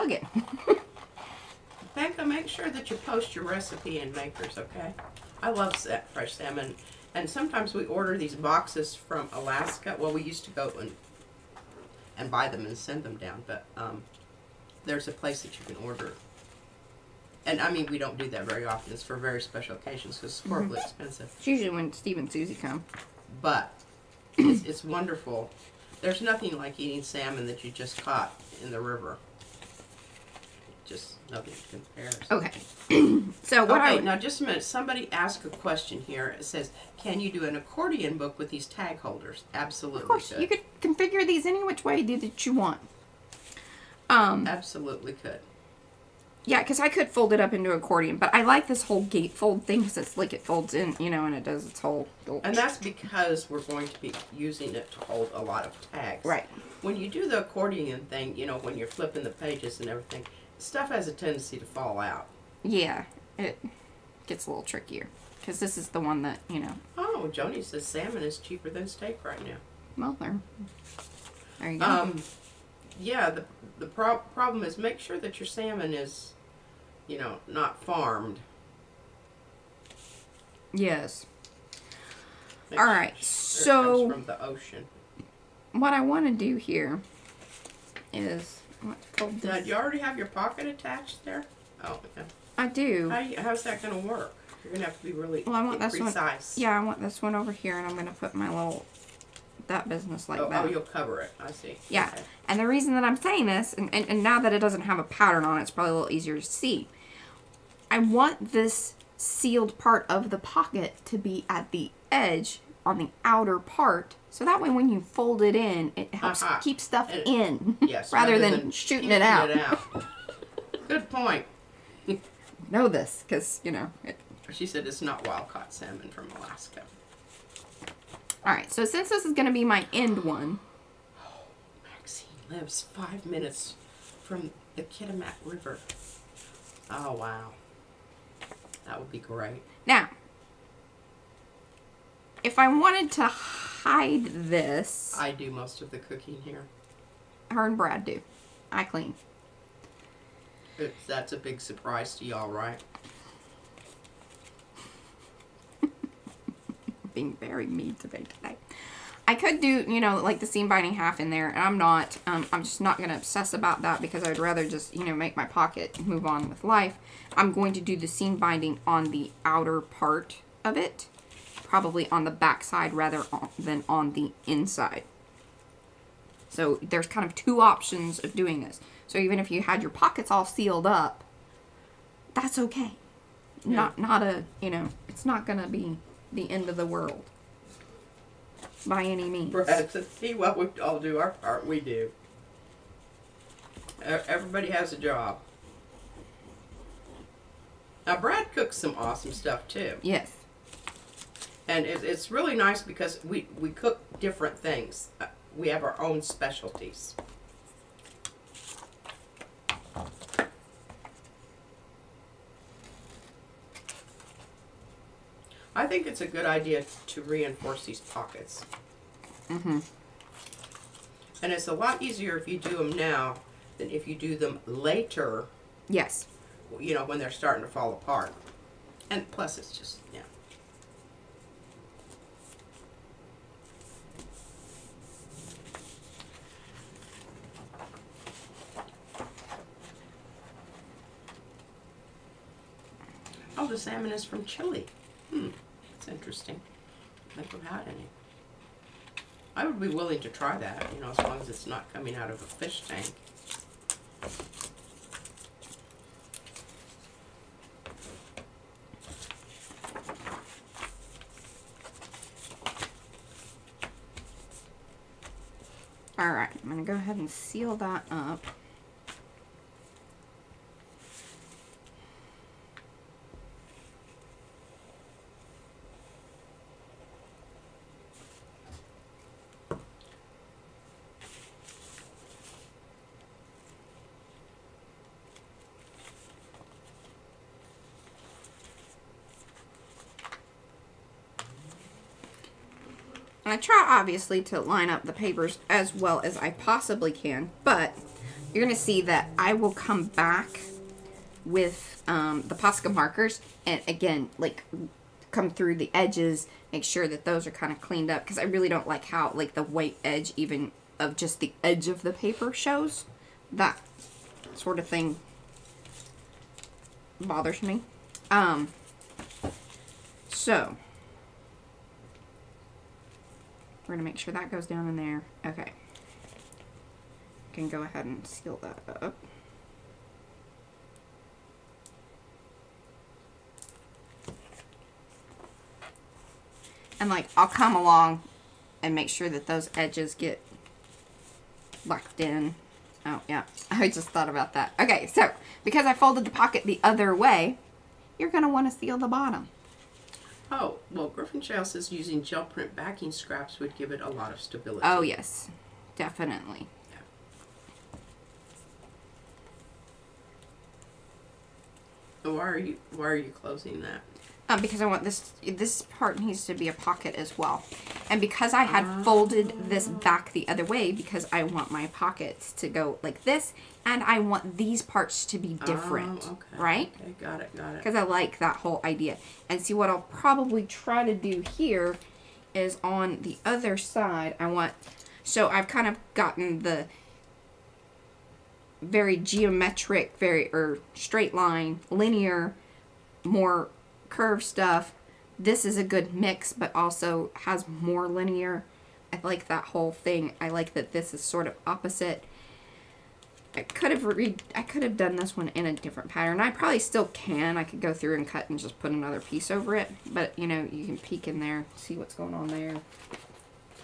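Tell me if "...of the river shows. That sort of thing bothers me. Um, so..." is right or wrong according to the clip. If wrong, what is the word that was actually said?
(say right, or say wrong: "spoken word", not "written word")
wrong: "paper", not "river".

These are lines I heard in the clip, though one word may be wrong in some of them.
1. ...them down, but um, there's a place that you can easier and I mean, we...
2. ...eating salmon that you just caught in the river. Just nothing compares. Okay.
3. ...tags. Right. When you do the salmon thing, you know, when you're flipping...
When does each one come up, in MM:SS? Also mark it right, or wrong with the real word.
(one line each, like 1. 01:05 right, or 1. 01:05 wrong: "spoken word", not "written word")
1. 00:13 wrong: "order", not "easier"
2. 00:26 right
3. 00:55 wrong: "accordion", not "salmon".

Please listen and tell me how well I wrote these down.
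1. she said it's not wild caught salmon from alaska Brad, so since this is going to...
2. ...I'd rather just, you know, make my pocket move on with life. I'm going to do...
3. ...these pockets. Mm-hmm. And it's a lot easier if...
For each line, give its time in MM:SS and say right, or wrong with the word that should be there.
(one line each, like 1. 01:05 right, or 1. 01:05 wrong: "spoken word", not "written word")
1. 02:04 wrong: "Alright", not "Brad"
2. 02:44 right
3. 03:37 right.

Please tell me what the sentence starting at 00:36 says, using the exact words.
It says, "Can you do an accordion book with these tag holders?" Absolutely.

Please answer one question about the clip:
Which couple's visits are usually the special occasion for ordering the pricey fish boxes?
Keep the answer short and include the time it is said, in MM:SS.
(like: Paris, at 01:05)
Steve and Susie, at 00:21.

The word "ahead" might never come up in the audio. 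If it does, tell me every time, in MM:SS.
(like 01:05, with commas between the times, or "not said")
04:26, 05:27.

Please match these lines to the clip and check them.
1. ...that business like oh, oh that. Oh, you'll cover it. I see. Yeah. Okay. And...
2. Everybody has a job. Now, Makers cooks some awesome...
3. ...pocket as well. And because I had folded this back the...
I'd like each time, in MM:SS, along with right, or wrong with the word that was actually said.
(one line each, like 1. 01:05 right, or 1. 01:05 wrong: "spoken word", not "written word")
1. 01:39 right
2. 03:14 wrong: "Brad", not "Makers"
3. 06:06 right.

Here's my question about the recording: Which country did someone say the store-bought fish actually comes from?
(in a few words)
Chile.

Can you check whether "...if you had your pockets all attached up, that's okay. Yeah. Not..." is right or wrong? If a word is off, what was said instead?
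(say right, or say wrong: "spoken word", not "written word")
wrong: "sealed", not "attached".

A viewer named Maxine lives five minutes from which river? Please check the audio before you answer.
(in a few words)
Kitimat River.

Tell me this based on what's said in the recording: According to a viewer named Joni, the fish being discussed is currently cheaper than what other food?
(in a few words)
Steak.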